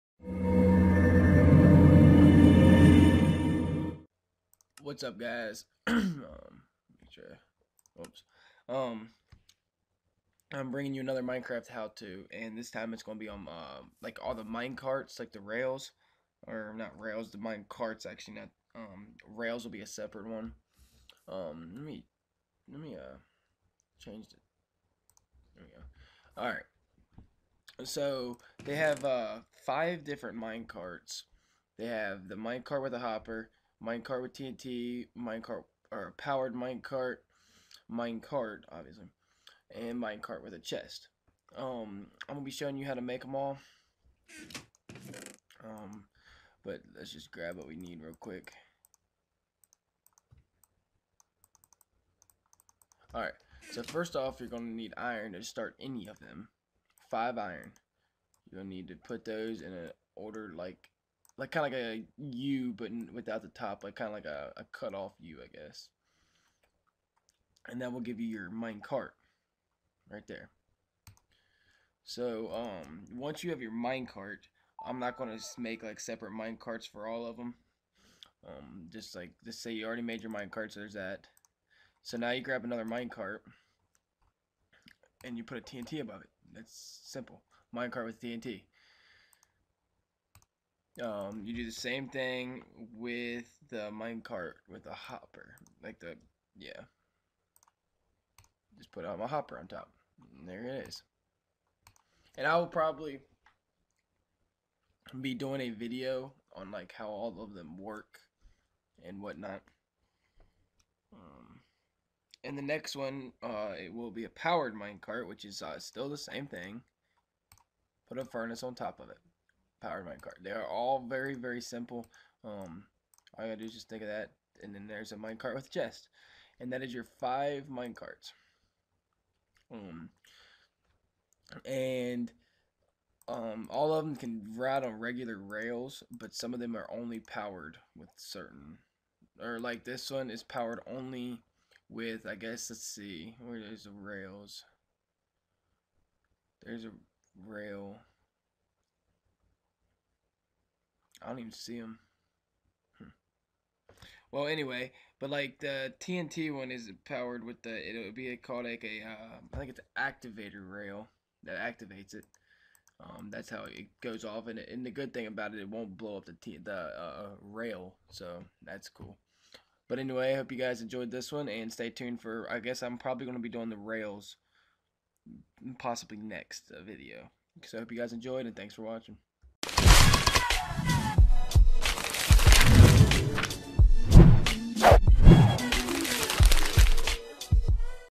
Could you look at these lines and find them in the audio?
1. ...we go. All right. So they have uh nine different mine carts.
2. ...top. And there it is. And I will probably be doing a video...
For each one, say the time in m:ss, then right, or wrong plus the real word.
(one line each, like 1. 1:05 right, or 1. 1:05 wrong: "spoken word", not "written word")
1. 0:25 wrong: "five", not "nine"
2. 1:39 right.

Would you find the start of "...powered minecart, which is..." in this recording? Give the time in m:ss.
1:54.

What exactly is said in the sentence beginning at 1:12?
So um, once you have your mine cart, I'm not gonna make like separate mine carts for all of them.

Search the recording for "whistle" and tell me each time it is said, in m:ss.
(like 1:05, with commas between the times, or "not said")
not said.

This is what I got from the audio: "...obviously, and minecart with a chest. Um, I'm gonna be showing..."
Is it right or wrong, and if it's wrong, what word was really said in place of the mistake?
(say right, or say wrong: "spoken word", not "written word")
right.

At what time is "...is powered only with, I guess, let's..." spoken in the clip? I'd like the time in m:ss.
2:20.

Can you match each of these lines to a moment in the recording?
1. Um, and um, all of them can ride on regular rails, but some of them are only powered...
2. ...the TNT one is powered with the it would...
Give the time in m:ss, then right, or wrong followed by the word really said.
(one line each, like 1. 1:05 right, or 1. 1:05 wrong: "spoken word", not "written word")
1. 2:09 right
2. 2:35 right.